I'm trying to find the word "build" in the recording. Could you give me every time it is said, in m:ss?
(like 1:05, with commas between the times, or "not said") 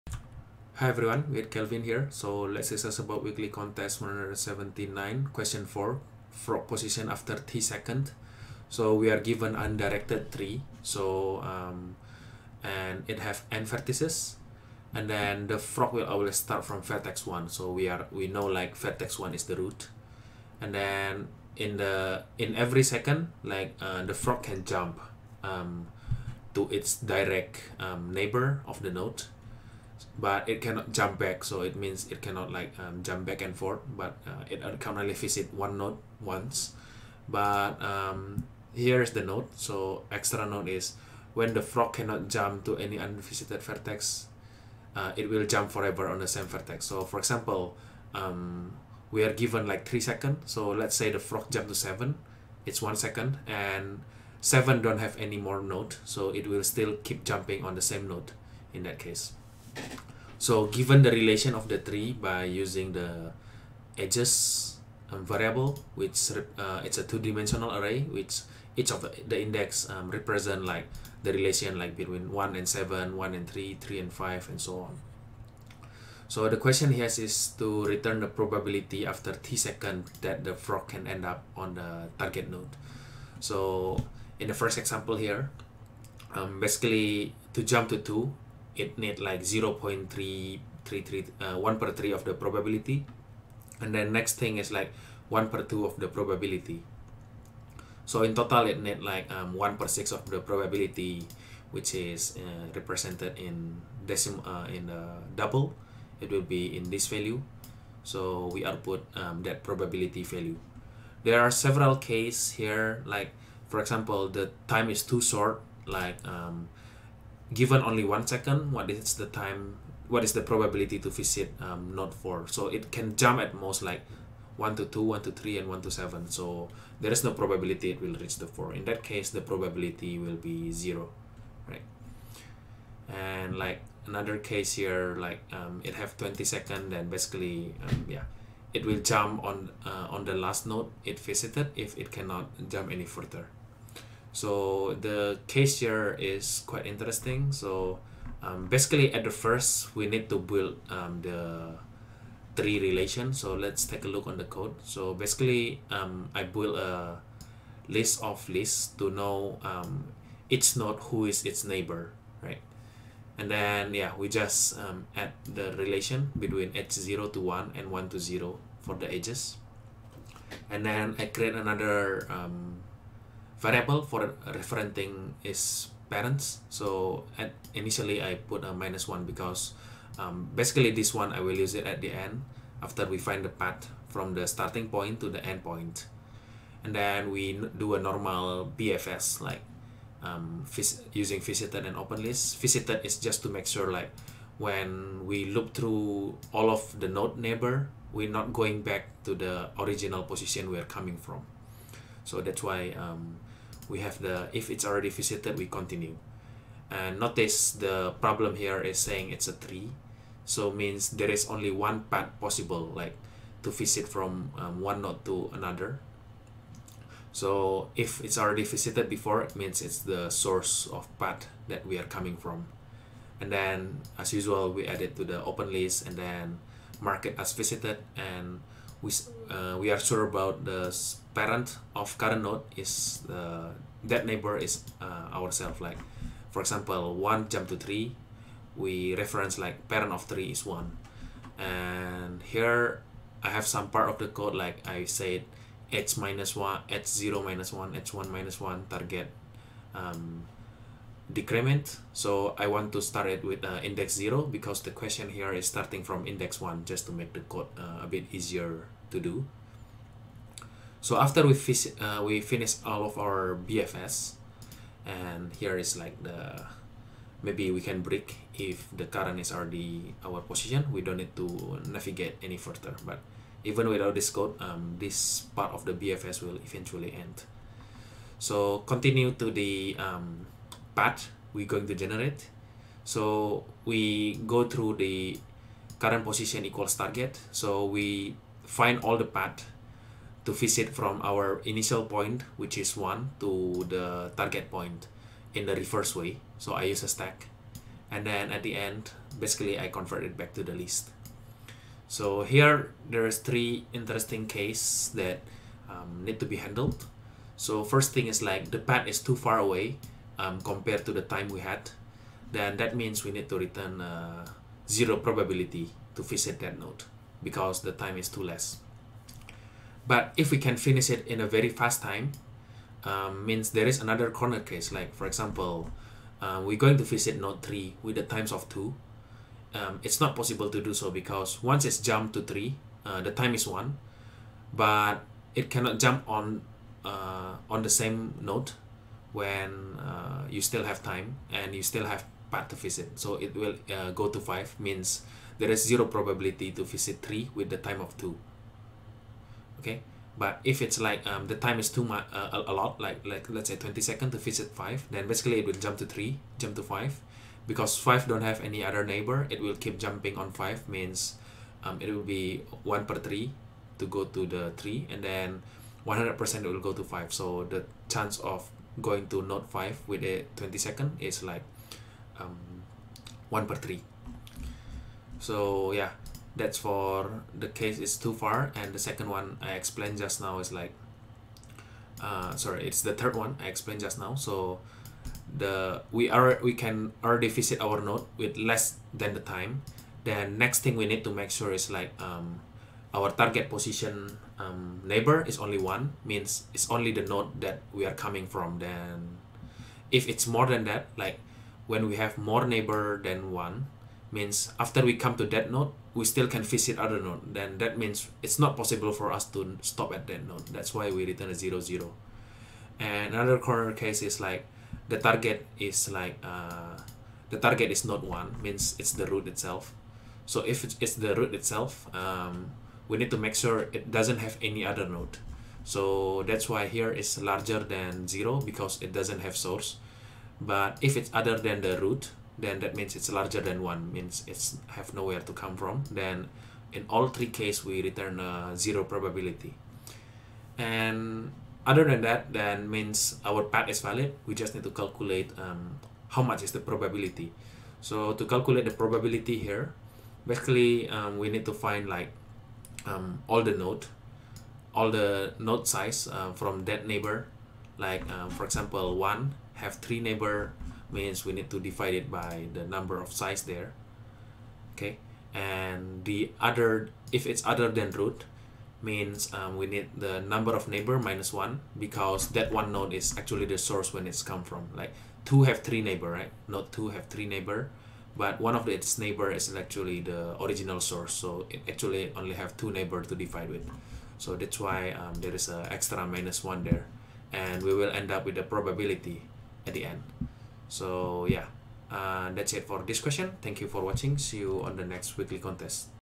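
2:30, 2:36.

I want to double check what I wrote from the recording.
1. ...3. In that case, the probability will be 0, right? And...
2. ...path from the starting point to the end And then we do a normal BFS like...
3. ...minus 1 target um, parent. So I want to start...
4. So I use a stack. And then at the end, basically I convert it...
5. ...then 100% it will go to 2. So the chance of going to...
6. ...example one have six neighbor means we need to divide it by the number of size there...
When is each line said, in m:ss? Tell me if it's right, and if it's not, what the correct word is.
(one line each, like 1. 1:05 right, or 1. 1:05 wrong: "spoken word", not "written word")
1. 2:08 wrong: "4", not "3"
2. 3:03 right
3. 4:08 wrong: "decrement", not "parent"
4. 4:56 right
5. 6:05 wrong: "5", not "2"
6. 7:38 wrong: "three", not "six".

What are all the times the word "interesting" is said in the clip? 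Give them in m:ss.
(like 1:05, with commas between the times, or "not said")
2:26, 5:03.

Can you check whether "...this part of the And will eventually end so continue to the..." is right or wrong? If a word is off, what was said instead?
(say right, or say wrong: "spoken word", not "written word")
wrong: "BFS", not "And".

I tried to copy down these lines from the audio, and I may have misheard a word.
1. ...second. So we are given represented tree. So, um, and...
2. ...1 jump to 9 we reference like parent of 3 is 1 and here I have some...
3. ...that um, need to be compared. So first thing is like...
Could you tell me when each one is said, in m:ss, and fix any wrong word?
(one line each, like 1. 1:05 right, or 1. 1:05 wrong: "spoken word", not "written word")
1. 0:07 wrong: "undirected", not "represented"
2. 3:57 wrong: "3", not "9"
3. 5:05 wrong: "handled", not "compared".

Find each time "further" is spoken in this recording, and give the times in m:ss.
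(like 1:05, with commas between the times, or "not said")
2:23, 4:32.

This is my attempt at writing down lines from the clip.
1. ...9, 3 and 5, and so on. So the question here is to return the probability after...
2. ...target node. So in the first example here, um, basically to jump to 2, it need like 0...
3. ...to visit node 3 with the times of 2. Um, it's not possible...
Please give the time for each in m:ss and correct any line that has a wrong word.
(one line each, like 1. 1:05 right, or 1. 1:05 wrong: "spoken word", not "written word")
1. 1:13 wrong: "3", not "9"
2. 1:22 right
3. 5:26 right.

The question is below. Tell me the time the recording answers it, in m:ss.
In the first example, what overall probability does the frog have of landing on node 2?
1:39.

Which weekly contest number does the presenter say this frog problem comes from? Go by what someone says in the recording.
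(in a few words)
179.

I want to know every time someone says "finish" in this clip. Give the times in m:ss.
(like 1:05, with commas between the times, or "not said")
4:22, 5:20.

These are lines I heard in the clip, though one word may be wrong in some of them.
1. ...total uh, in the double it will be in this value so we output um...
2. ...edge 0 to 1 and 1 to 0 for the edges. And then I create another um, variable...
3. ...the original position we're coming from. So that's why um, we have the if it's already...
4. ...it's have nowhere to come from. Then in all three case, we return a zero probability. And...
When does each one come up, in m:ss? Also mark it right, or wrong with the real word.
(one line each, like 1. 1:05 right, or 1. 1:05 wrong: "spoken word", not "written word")
1. 1:44 wrong: "decimal", not "total"
2. 2:46 right
3. 3:19 right
4. 7:14 right.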